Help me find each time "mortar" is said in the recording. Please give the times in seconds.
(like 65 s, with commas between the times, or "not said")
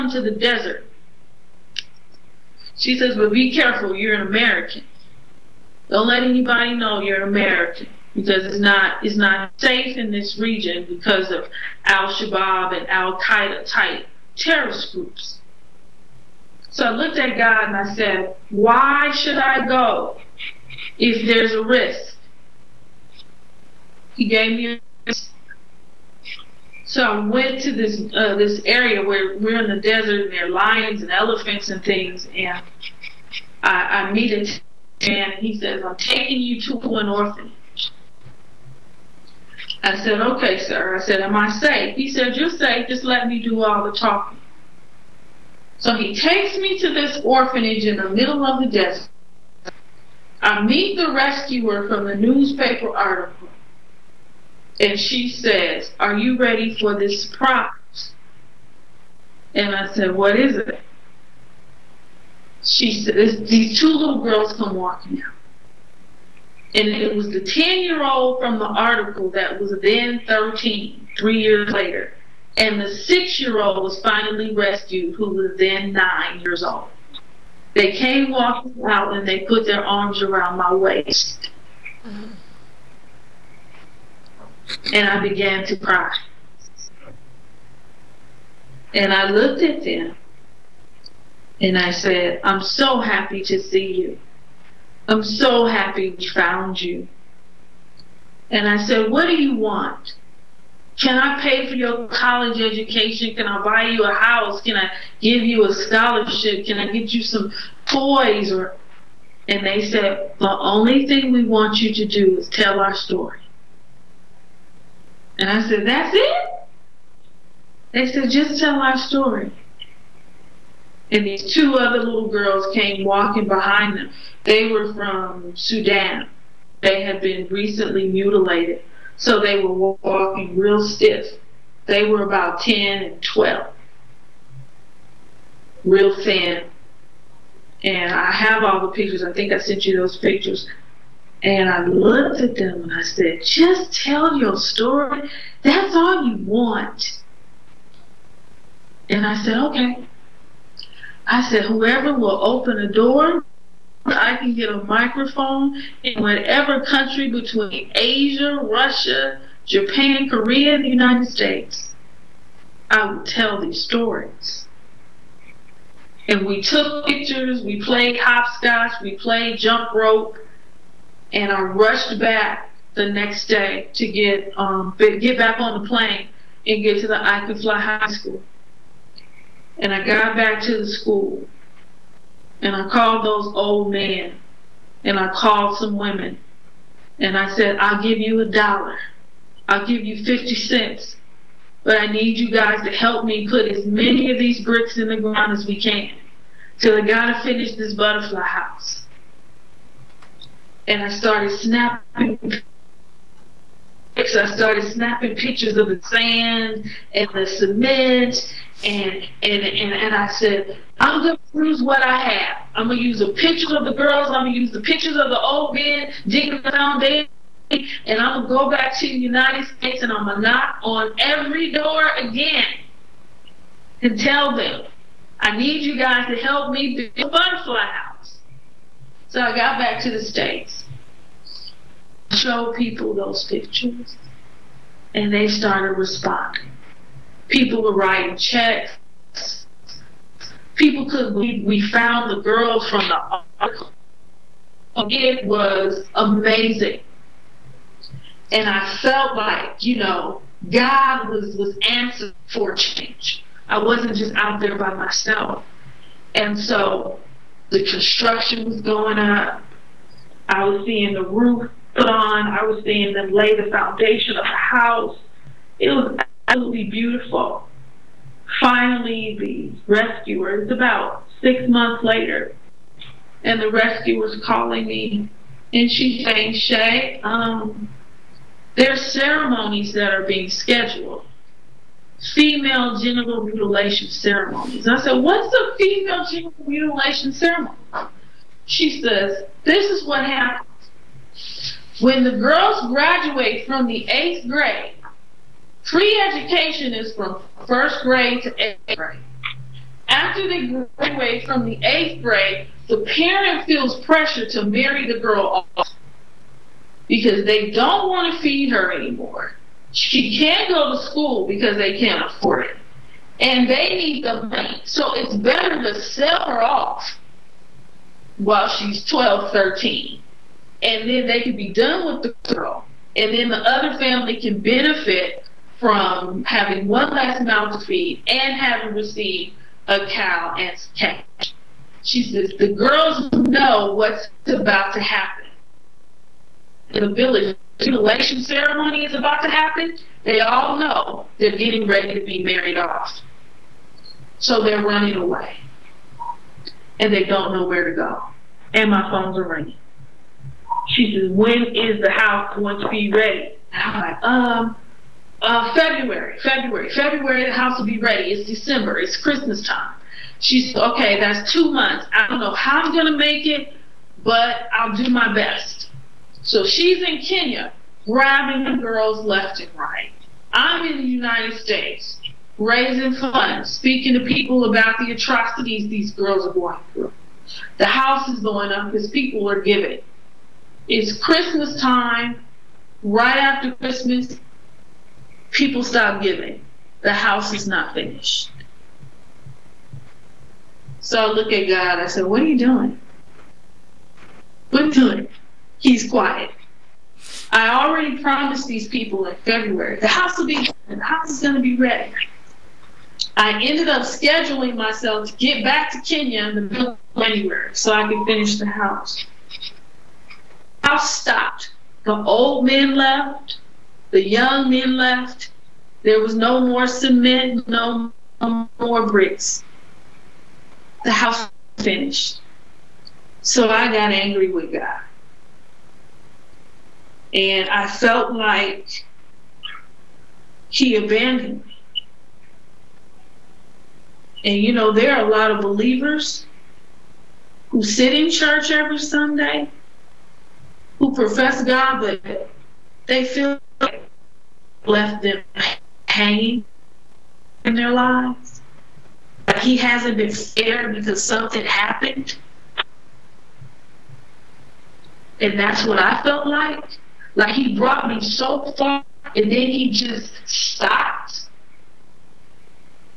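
not said.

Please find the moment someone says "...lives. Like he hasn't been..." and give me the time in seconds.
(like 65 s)
447 s.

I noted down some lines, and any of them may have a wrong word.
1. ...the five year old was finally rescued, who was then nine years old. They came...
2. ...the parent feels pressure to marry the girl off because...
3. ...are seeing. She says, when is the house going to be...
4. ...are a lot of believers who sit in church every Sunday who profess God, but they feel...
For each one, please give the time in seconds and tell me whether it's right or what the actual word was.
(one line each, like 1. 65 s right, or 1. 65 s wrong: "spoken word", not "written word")
1. 72 s wrong: "six", not "five"
2. 302 s right
3. 349 s wrong: "ringing", not "seeing"
4. 435 s right.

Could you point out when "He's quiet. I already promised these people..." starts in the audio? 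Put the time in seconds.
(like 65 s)
395 s.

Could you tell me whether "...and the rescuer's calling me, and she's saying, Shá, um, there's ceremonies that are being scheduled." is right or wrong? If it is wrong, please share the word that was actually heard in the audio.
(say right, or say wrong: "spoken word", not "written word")
right.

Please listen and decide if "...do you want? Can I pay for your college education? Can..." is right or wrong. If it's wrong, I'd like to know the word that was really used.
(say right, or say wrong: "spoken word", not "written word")
right.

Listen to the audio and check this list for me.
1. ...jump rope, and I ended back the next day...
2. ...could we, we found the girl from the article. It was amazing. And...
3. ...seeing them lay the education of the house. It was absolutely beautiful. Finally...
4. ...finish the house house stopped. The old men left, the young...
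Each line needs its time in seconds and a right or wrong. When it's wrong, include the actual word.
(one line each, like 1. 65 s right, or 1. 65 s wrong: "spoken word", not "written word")
1. 169 s wrong: "rushed", not "ended"
2. 241 s right
3. 262 s wrong: "foundation", not "education"
4. 408 s right.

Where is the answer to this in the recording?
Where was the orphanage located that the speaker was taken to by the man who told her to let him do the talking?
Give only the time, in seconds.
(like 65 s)
47 s.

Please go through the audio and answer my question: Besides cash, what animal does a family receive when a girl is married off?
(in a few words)
A cow.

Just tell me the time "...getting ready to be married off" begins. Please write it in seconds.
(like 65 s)
341 s.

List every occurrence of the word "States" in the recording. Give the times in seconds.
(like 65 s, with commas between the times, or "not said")
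161 s, 219 s, 230 s, 371 s.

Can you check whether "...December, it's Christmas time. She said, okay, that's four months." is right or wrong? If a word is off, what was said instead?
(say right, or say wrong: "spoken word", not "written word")
wrong: "two", not "four".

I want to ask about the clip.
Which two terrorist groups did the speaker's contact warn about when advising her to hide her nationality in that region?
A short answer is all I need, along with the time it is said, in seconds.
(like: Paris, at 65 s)
Al Shabaab and Al Qaeda, at 11 s.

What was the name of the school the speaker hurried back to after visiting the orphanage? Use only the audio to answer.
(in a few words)
I Could Fly High School.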